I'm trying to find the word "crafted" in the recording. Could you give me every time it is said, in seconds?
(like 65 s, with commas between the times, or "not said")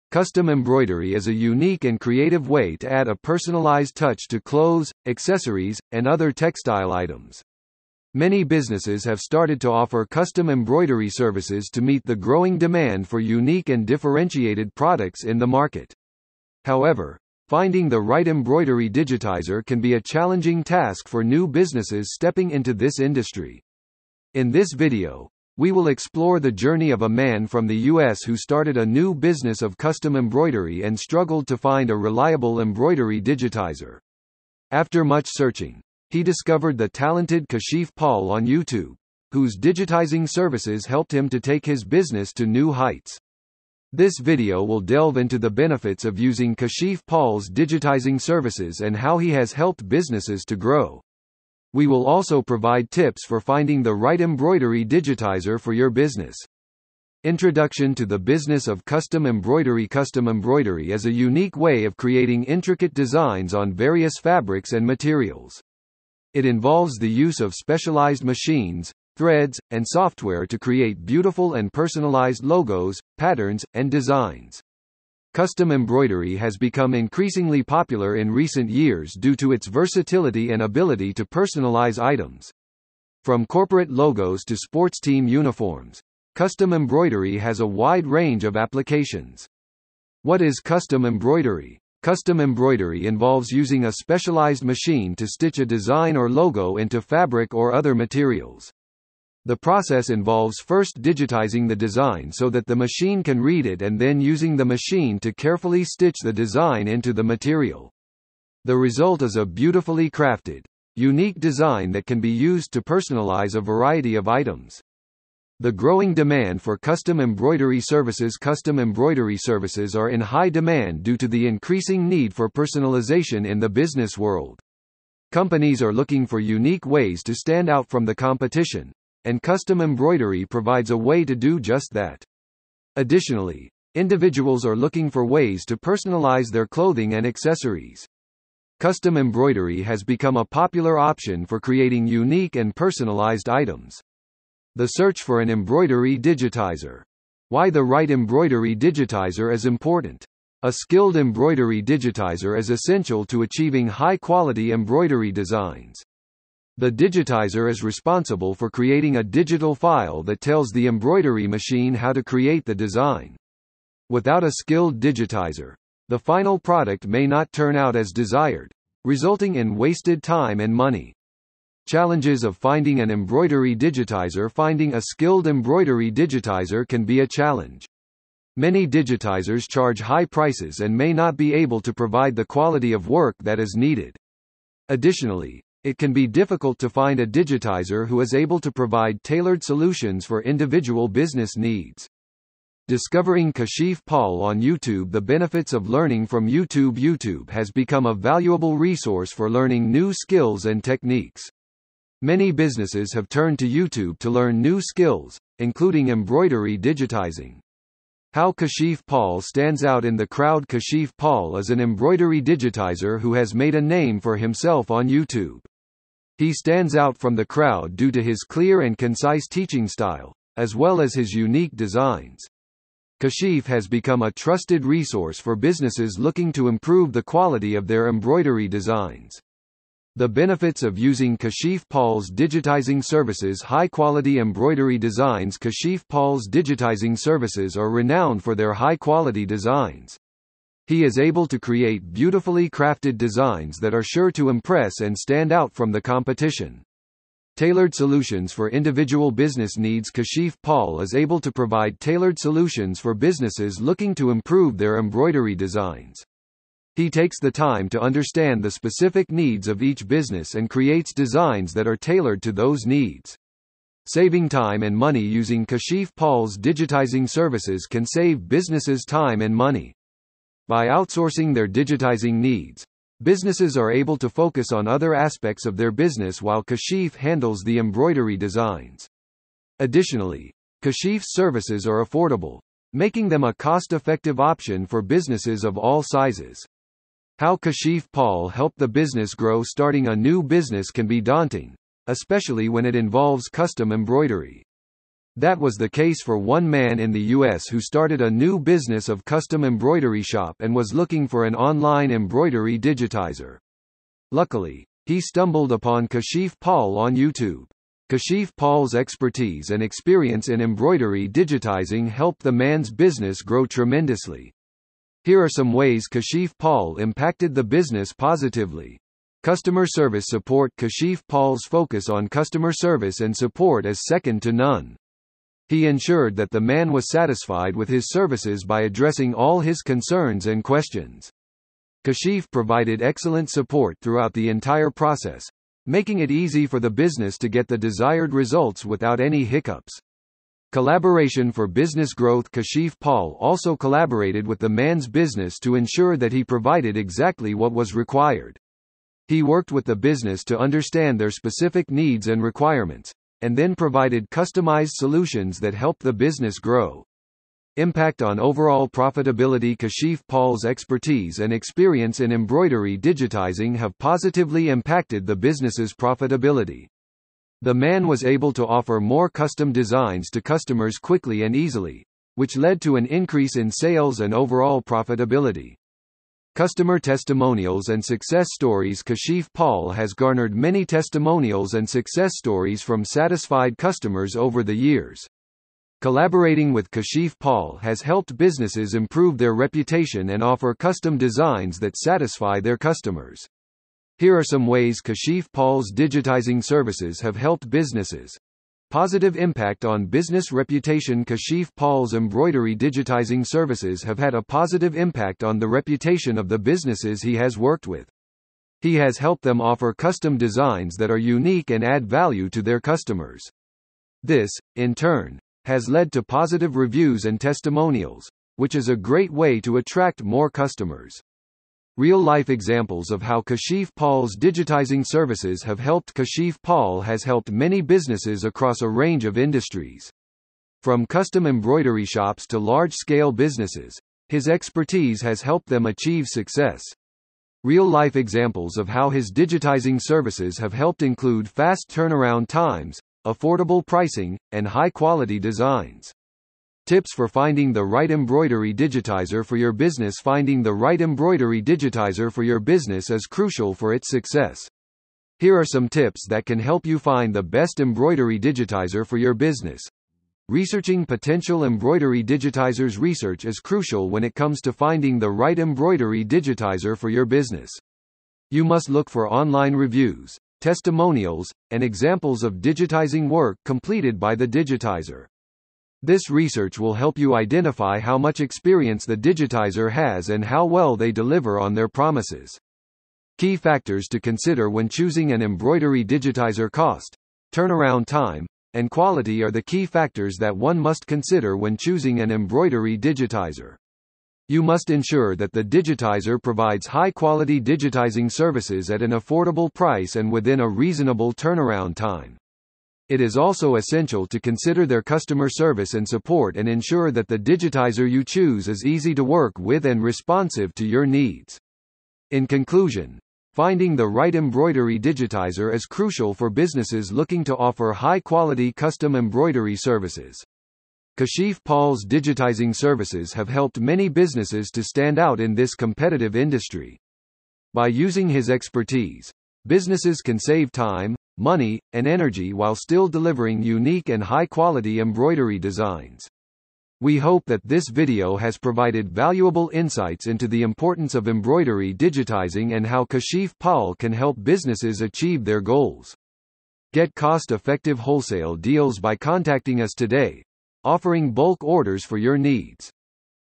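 110 s, 242 s.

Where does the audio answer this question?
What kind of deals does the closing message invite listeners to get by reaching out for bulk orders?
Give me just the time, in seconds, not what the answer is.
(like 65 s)
547 s.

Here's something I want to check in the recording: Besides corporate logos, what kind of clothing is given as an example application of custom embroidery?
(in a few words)
Sports team uniforms.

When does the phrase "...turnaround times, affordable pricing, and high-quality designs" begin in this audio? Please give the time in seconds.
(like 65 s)
441 s.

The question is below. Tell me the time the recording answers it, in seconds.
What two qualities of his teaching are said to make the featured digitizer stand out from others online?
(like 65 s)
218 s.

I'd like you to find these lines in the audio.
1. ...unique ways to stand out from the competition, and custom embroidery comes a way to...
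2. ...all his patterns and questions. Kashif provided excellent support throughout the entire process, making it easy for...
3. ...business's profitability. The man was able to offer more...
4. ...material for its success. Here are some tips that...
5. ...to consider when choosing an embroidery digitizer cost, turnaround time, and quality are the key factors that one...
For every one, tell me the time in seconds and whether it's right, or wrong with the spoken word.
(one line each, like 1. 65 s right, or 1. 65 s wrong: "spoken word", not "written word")
1. 126 s wrong: "provides", not "comes"
2. 329 s wrong: "concerns", not "patterns"
3. 365 s right
4. 453 s wrong: "crucial", not "material"
5. 484 s right.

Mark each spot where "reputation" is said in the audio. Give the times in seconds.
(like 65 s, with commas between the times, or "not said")
389 s, 400 s, 405 s.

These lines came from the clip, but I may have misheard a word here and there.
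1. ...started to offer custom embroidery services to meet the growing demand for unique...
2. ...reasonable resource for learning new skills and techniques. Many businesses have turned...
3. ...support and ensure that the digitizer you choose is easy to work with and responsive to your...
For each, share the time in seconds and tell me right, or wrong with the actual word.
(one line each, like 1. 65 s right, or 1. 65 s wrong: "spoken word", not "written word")
1. 9 s right
2. 198 s wrong: "valuable", not "reasonable"
3. 506 s right.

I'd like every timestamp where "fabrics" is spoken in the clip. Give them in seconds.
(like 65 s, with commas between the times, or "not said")
64 s, 97 s.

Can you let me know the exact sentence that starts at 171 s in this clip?
Challenges of finding an embroidery digitizer Finding a skilled embroidery digitizer can be a challenge.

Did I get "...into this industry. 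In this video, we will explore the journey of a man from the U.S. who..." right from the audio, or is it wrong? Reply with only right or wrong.
right.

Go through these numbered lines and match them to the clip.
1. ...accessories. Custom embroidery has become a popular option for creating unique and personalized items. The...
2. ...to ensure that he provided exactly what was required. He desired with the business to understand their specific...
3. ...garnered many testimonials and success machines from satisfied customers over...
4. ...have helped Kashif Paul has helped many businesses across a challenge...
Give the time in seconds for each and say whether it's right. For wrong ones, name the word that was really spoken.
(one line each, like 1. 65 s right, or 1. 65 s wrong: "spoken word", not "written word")
1. 137 s right
2. 345 s wrong: "worked", not "desired"
3. 380 s wrong: "stories", not "machines"
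4. 425 s wrong: "range", not "challenge".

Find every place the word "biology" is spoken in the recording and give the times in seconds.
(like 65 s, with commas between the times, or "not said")
not said.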